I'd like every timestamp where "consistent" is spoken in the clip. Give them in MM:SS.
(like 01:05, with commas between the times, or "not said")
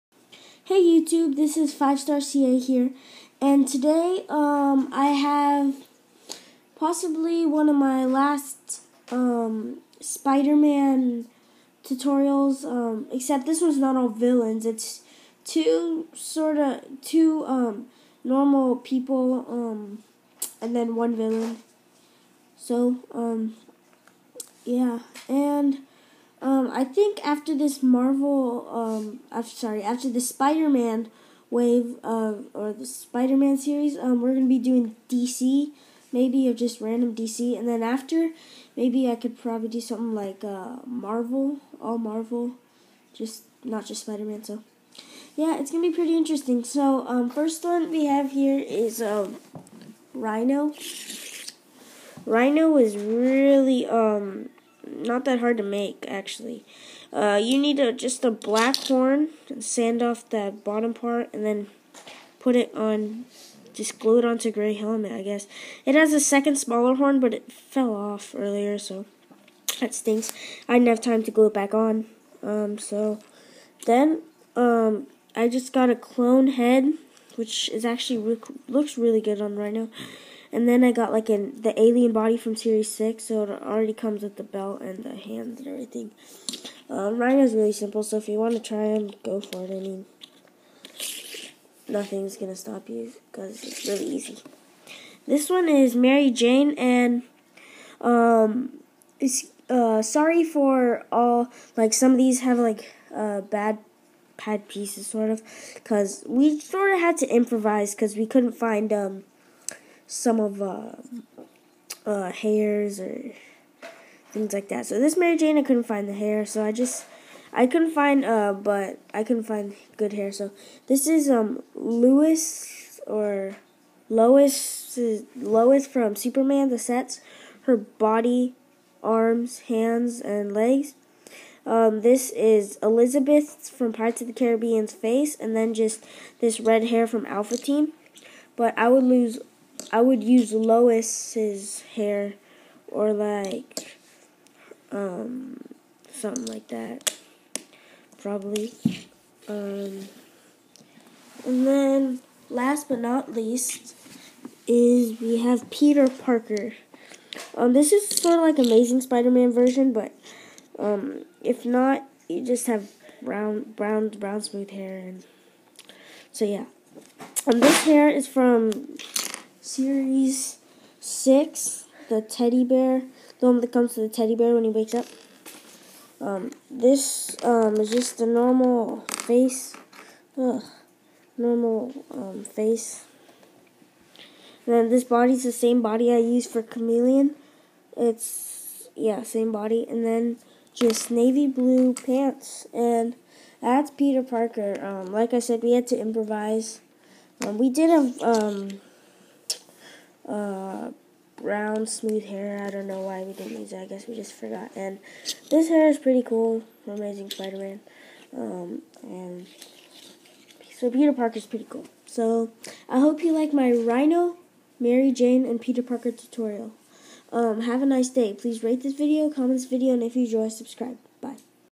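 not said.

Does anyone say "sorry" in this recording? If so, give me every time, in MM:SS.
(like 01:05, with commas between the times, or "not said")
00:29, 01:40.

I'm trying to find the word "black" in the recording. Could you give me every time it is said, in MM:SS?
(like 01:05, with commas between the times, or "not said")
00:58.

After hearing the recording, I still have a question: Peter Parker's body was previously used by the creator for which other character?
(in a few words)
Chameleon.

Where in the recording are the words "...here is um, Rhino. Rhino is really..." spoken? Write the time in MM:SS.
00:48.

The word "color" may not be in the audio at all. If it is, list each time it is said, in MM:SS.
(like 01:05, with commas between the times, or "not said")
not said.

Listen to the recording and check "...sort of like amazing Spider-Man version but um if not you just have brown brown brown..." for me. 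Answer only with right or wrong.
right.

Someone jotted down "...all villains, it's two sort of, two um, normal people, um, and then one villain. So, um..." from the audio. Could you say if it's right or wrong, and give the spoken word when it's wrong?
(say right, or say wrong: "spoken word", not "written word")
right.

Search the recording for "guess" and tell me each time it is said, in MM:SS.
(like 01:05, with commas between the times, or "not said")
01:05, 03:23.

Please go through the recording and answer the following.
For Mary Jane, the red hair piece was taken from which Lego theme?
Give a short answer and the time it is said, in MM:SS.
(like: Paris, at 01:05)
Alpha Team, at 02:17.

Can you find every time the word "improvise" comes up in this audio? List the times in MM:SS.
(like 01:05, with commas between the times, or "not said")
01:47, 03:15.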